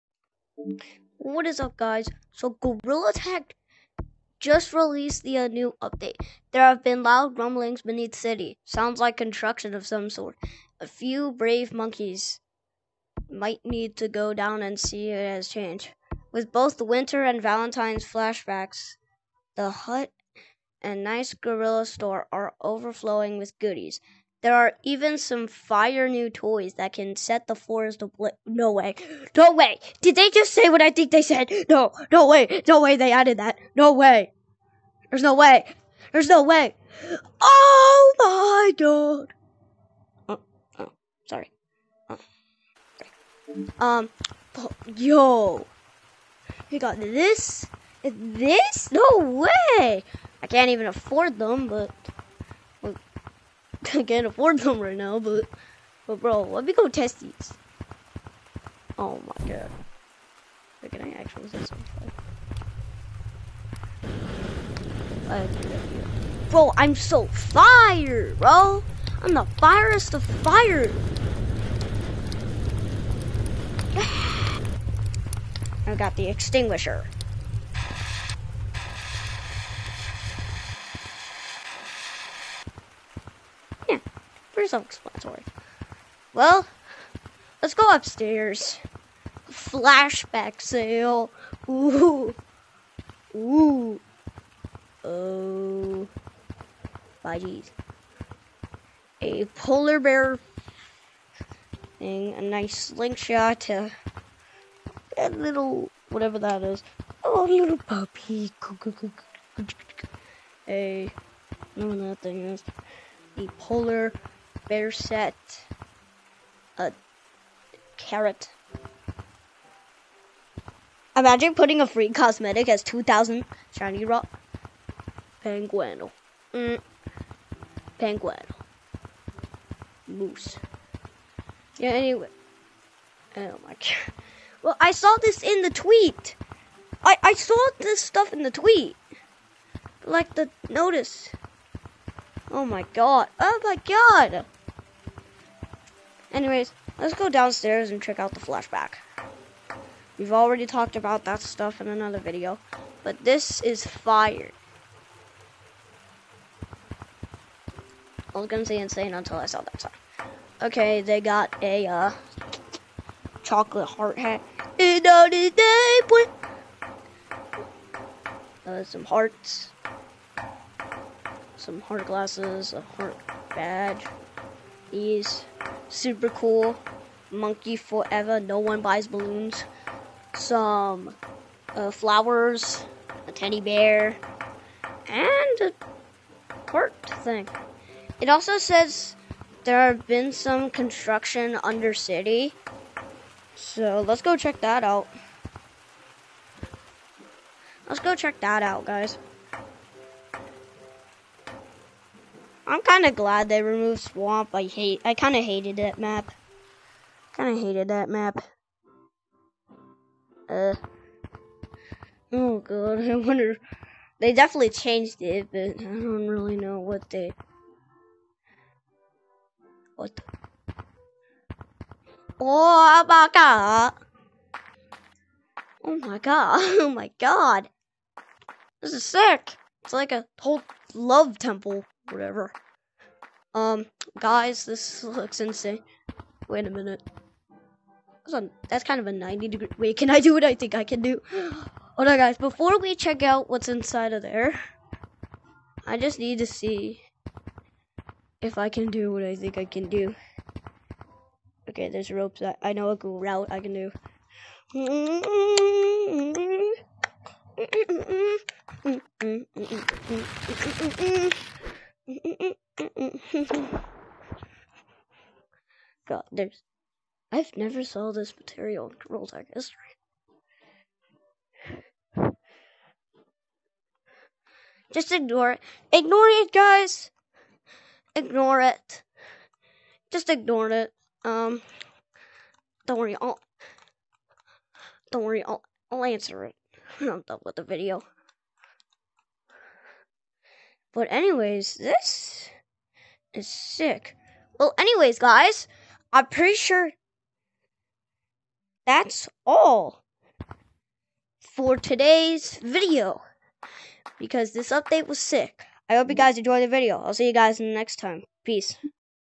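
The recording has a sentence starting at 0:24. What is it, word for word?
There are even some fire new toys that can set the floors to No way.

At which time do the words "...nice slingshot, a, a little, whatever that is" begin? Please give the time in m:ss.
1:42.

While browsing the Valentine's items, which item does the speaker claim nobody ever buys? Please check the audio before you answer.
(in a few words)
Balloons.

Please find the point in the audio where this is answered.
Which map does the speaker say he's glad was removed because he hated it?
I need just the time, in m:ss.
3:23.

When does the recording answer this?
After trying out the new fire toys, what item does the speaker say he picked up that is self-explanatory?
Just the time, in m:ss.
1:16.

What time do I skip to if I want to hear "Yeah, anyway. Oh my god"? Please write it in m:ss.
2:11.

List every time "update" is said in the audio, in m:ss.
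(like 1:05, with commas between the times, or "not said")
0:05, 5:04.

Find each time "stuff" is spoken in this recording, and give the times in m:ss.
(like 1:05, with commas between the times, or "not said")
2:17, 2:31.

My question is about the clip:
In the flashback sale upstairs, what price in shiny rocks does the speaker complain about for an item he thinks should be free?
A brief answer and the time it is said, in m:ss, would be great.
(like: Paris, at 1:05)
2,000, at 2:02.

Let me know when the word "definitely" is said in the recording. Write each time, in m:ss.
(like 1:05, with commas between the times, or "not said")
3:34.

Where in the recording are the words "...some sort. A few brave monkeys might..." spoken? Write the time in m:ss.
0:09.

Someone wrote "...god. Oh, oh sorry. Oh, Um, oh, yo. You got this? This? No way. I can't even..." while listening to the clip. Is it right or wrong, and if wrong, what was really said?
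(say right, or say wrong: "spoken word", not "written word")
right.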